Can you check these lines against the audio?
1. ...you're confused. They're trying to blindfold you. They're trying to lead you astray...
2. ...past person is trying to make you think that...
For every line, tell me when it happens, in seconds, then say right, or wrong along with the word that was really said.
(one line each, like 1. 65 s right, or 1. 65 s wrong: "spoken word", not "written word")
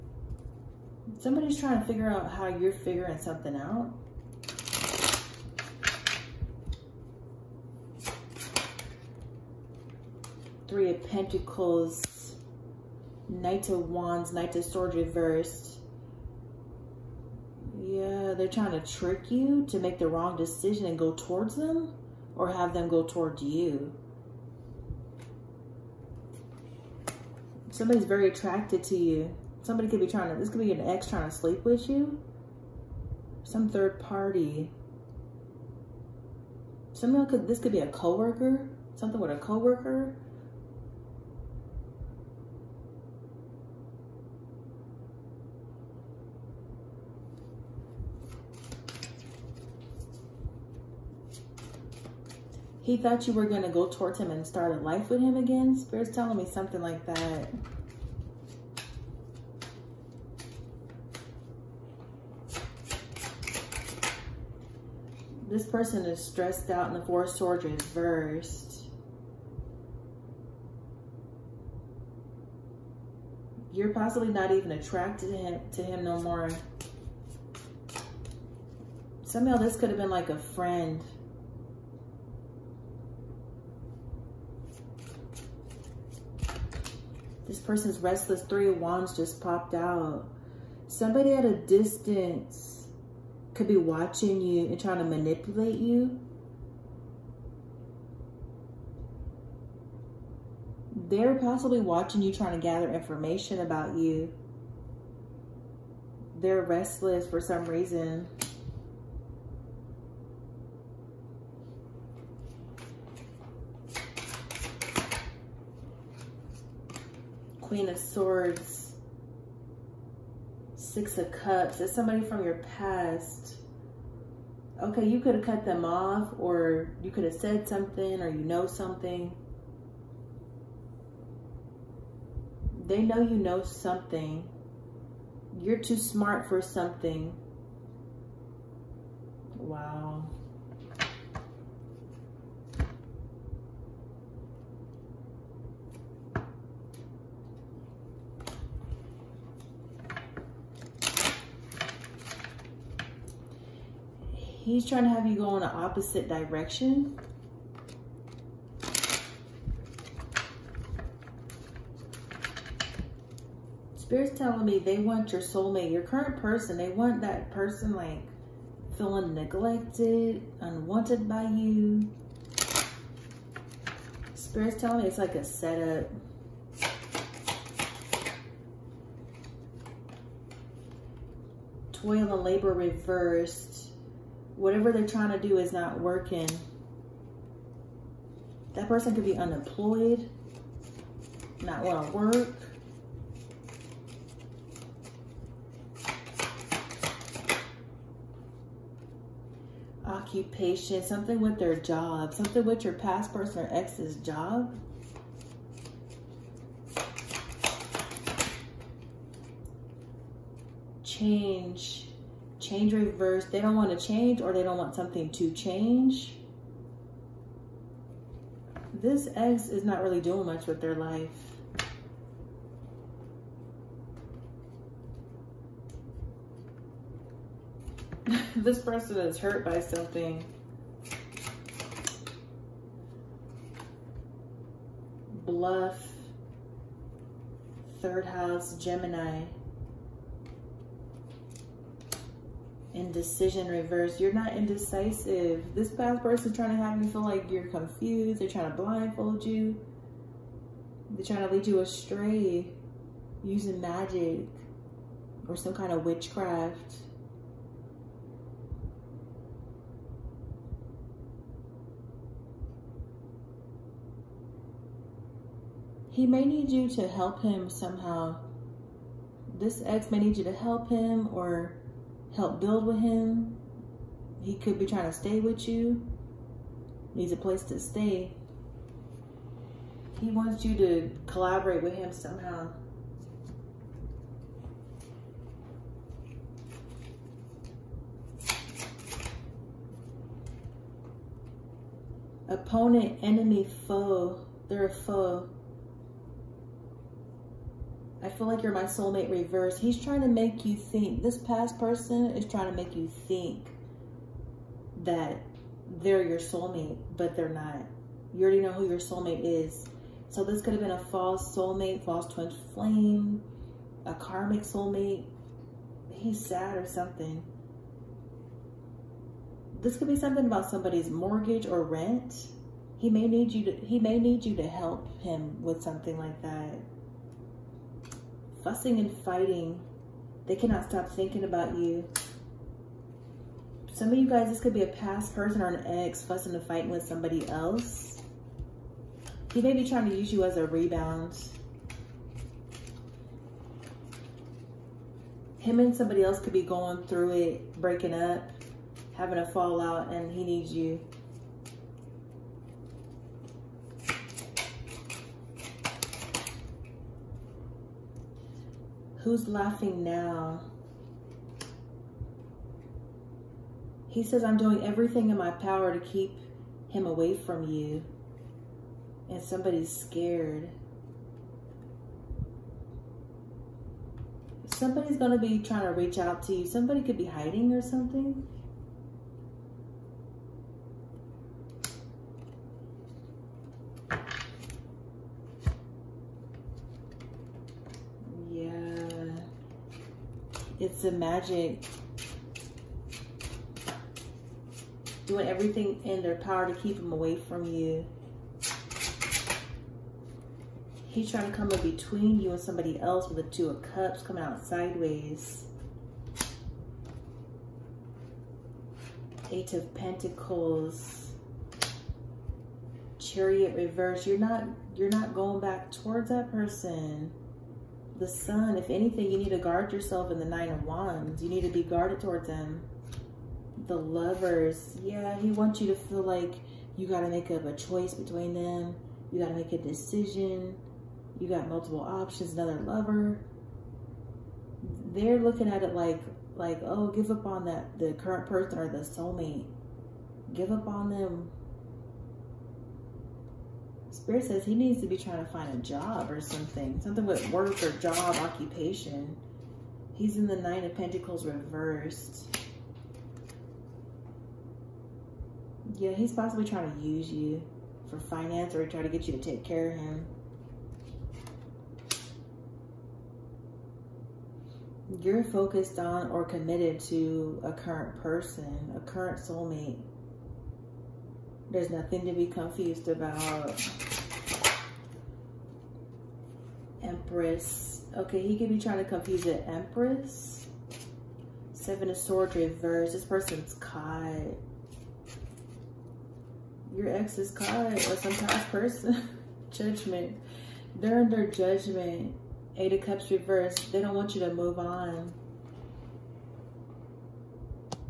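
1. 247 s right
2. 301 s right.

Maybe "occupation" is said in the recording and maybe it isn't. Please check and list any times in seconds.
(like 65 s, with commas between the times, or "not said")
200 s, 448 s.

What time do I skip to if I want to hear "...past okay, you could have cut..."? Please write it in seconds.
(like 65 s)
122 s.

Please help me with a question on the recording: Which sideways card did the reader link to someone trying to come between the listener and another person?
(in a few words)
Two of Cups.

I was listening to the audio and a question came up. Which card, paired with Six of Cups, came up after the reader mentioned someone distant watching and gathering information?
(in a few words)
Queen of Swords.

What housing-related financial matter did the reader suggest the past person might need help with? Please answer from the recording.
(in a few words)
mortgage or rent.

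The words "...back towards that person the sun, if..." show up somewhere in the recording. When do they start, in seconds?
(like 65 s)
415 s.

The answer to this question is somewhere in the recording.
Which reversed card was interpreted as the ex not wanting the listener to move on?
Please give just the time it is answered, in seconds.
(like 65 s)
492 s.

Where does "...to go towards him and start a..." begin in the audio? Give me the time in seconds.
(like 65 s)
53 s.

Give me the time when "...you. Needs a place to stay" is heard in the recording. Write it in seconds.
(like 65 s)
275 s.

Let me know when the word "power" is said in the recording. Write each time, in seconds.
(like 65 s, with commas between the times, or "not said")
365 s, 396 s.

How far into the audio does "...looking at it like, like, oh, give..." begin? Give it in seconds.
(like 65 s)
435 s.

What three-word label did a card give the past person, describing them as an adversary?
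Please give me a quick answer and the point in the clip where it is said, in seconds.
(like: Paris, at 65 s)
Opponent, enemy, foe, at 292 s.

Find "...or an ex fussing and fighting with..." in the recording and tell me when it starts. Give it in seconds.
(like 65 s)
335 s.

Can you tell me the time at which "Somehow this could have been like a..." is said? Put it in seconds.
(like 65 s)
79 s.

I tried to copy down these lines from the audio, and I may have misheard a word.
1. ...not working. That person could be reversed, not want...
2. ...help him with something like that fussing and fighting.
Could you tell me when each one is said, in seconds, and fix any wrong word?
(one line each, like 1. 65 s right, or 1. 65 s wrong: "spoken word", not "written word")
1. 185 s wrong: "unemployed", not "reversed"
2. 324 s right.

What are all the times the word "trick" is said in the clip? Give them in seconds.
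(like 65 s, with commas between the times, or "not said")
18 s.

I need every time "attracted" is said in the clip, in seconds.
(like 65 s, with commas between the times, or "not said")
28 s, 74 s.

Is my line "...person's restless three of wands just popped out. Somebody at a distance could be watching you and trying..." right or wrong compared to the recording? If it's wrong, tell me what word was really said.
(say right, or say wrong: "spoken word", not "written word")
right.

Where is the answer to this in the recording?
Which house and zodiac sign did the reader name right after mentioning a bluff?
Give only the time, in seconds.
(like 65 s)
238 s.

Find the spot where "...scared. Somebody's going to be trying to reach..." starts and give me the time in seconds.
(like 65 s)
369 s.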